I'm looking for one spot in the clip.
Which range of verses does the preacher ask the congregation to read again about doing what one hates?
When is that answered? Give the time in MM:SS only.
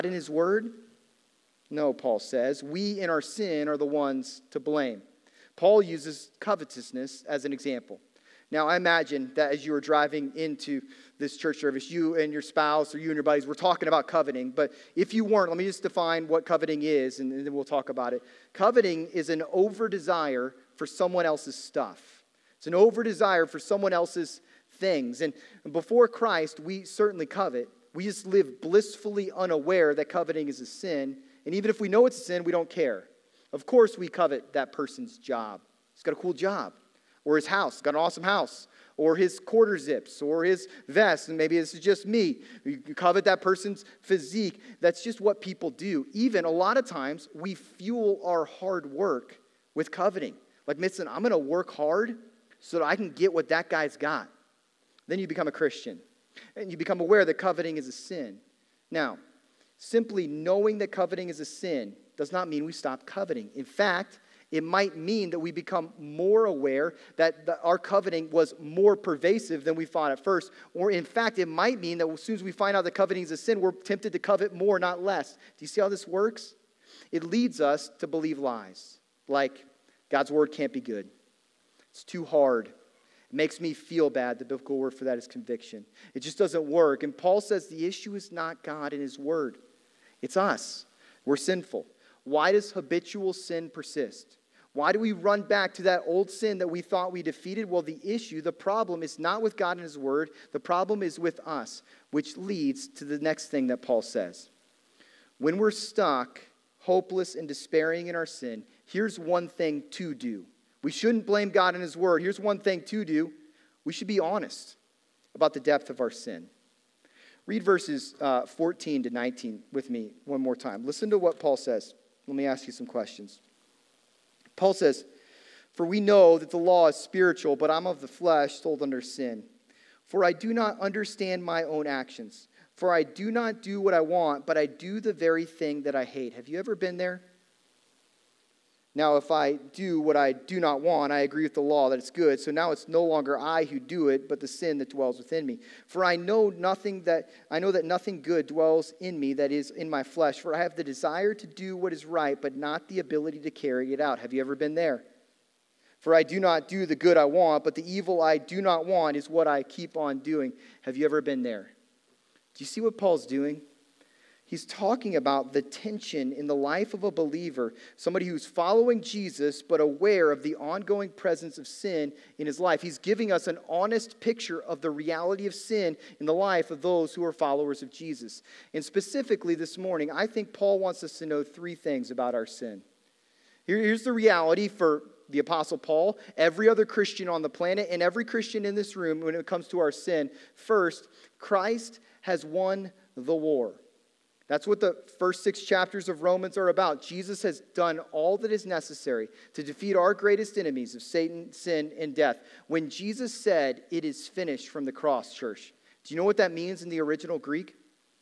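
01:58.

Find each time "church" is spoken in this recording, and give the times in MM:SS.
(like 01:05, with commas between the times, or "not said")
00:11, 03:25.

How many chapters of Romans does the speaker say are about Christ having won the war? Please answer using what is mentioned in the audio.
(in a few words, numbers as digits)
6.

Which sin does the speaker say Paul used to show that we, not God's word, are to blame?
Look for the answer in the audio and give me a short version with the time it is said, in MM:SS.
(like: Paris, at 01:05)
covetousness, at 00:06.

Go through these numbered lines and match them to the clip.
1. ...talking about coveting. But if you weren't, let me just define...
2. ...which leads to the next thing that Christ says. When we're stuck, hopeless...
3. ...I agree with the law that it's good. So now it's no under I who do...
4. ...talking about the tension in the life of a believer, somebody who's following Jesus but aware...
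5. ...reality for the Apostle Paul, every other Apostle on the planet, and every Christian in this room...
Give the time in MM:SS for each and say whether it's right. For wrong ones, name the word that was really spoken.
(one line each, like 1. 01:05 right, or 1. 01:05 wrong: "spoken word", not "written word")
1. 00:13 right
2. 01:42 wrong: "Paul", not "Christ"
3. 02:21 wrong: "longer", not "under"
4. 02:44 right
5. 03:04 wrong: "Christian", not "Apostle".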